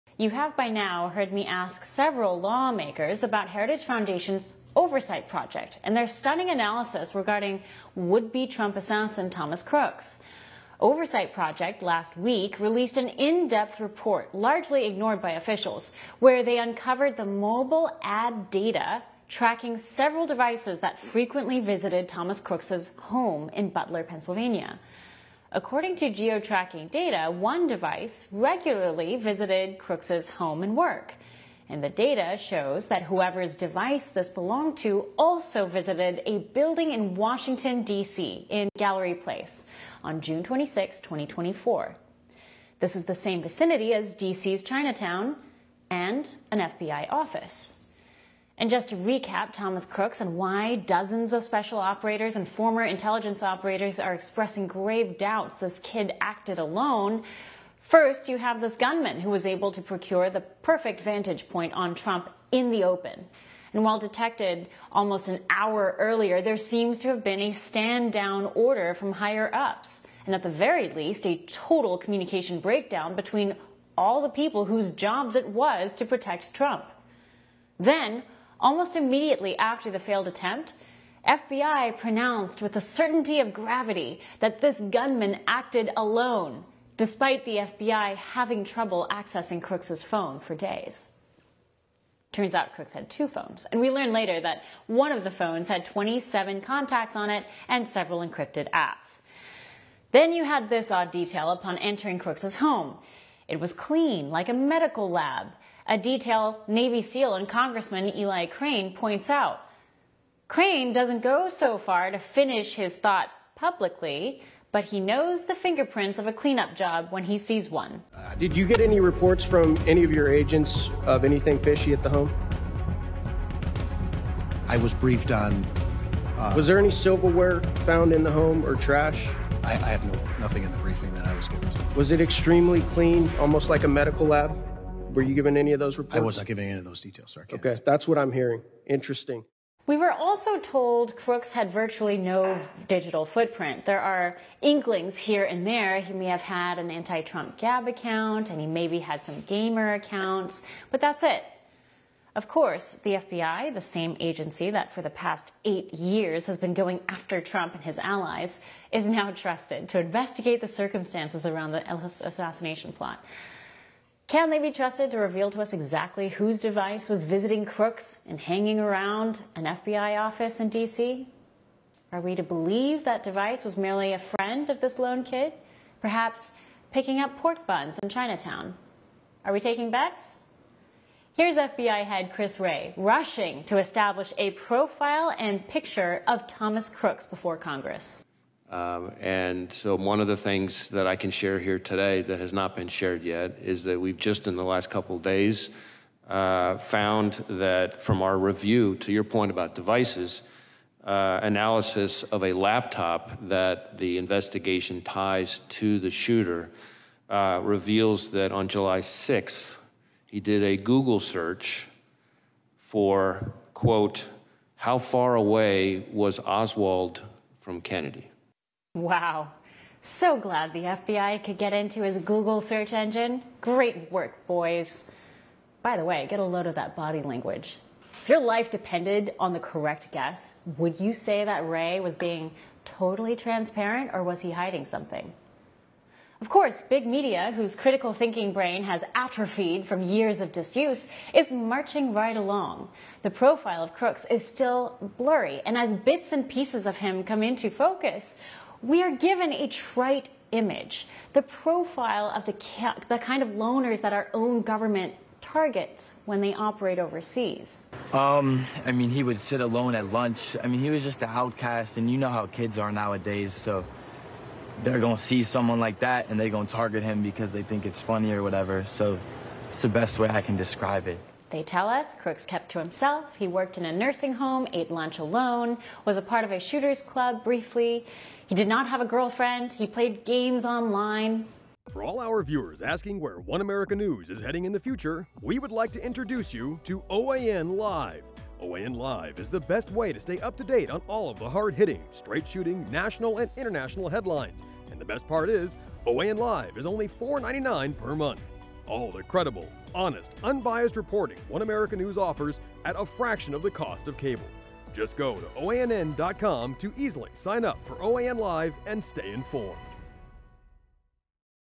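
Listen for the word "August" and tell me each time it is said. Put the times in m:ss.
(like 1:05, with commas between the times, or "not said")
not said.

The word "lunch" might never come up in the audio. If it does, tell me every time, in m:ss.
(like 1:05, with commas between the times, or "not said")
4:20, 4:34.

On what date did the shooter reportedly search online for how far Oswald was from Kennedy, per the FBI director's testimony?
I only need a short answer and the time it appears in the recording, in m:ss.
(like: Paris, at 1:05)
July 6th, at 3:28.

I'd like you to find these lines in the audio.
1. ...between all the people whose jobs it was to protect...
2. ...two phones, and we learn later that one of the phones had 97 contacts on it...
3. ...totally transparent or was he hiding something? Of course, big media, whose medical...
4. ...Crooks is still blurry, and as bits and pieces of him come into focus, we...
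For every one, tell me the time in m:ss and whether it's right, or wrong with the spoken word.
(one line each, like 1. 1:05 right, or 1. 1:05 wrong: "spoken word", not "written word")
1. 1:13 right
2. 1:33 wrong: "27", not "97"
3. 3:52 wrong: "critical", not "medical"
4. 4:03 right.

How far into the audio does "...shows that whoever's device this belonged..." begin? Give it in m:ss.
0:32.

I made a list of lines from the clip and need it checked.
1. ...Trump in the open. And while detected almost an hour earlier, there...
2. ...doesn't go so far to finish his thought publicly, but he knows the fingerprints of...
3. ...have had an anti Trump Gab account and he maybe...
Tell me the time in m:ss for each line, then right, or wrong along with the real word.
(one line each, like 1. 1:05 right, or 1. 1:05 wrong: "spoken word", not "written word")
1. 1:01 right
2. 1:50 right
3. 2:26 right.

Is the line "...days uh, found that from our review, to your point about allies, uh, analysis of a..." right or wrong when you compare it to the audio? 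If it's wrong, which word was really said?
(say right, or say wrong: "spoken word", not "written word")
wrong: "devices", not "allies".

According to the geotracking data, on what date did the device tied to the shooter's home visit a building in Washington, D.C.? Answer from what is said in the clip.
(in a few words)
June 26, 2024.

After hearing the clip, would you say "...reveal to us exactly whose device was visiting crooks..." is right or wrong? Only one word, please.
right.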